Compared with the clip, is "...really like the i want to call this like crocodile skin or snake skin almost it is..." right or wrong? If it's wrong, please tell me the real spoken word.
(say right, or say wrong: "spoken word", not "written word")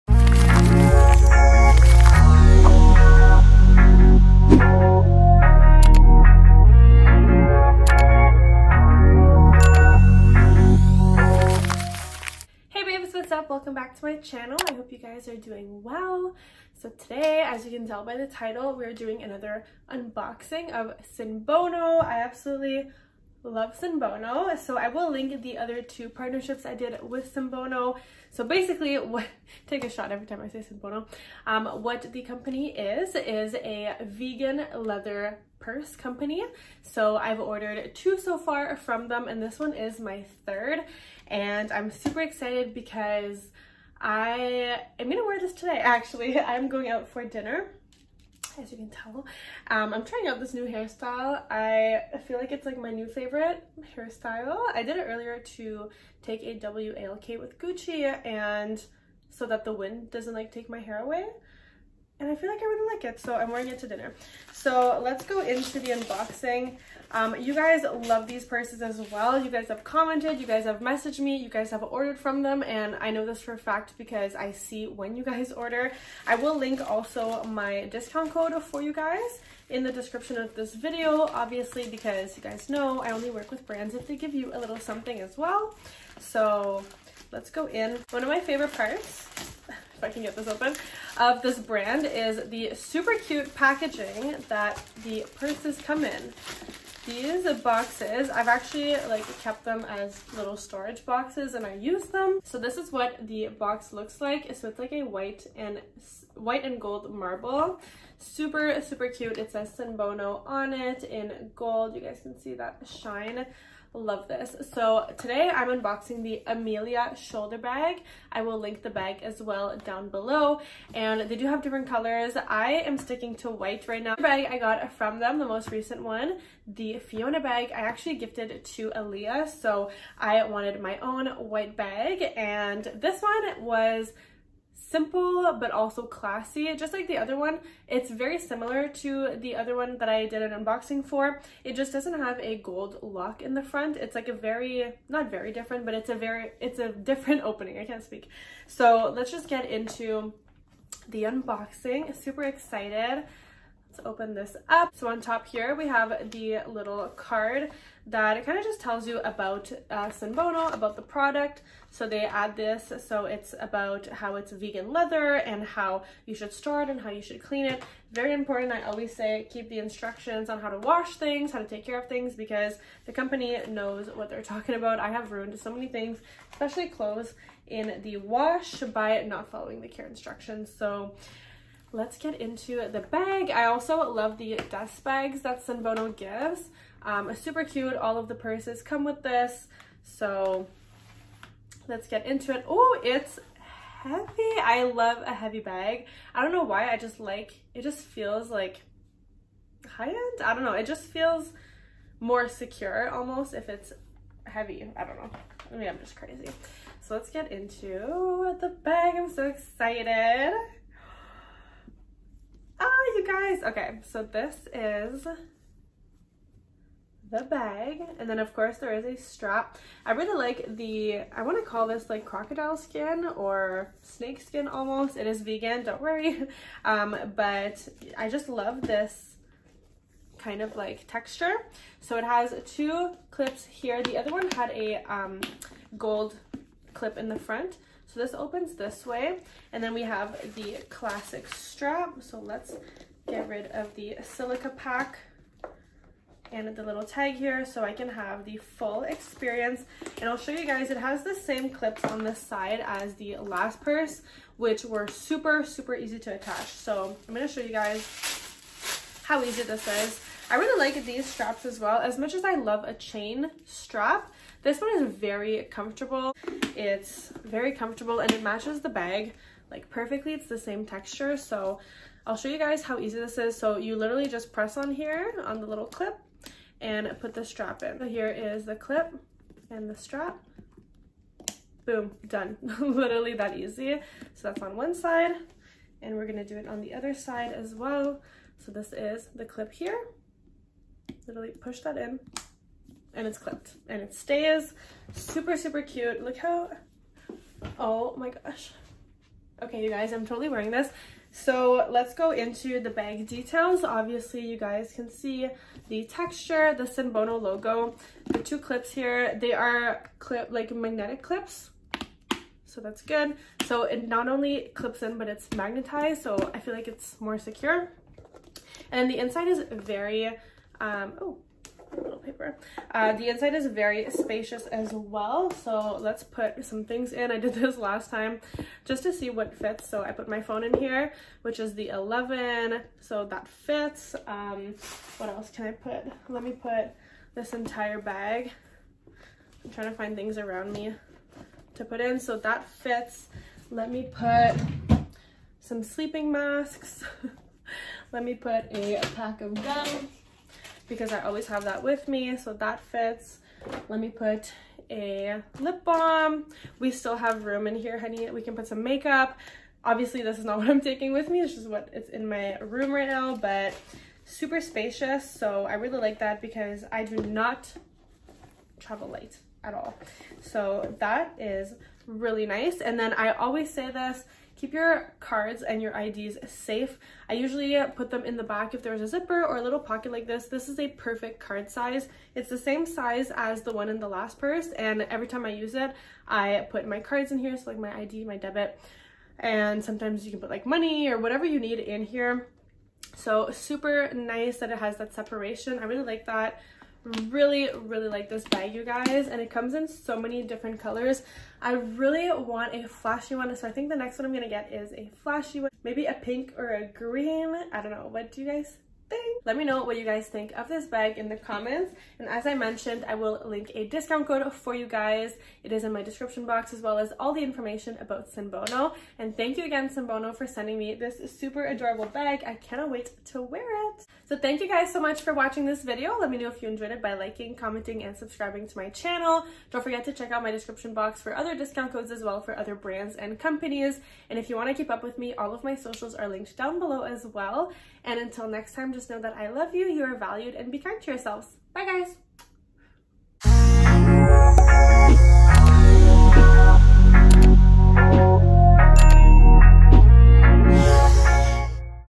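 right.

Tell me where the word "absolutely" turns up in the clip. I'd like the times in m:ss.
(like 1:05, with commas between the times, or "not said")
0:22.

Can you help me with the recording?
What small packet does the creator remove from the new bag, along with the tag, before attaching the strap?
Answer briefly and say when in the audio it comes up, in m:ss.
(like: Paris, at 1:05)
Silica pack, at 4:04.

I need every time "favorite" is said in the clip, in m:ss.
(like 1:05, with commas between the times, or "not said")
0:53, 1:28.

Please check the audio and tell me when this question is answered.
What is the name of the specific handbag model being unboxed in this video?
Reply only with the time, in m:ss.
1:56.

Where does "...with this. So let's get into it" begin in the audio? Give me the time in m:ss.
3:09.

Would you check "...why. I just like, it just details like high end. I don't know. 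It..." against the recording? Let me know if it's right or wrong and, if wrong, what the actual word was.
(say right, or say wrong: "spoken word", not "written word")
wrong: "feels", not "details".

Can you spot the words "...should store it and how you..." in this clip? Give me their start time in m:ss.
2:46.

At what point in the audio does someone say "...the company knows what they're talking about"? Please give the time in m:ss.
2:53.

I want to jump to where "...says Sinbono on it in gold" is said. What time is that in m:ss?
1:49.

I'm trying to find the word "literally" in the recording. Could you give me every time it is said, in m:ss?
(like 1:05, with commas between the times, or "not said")
4:33, 4:42, 4:51.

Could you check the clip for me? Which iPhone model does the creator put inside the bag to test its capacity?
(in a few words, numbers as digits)
11.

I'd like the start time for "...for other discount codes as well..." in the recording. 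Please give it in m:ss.
7:11.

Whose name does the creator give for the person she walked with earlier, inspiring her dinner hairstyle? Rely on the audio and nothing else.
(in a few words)
Gucci.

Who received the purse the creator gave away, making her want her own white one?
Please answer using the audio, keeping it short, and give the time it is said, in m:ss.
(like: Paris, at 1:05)
Aaliyah, at 2:08.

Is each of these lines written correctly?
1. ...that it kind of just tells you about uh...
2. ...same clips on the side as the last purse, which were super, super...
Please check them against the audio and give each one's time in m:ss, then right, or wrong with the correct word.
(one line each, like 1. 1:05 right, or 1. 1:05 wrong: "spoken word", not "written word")
1. 2:38 right
2. 4:11 right.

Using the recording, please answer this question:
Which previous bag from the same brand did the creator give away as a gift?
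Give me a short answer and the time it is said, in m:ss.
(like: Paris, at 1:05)
Fiona bag, at 2:06.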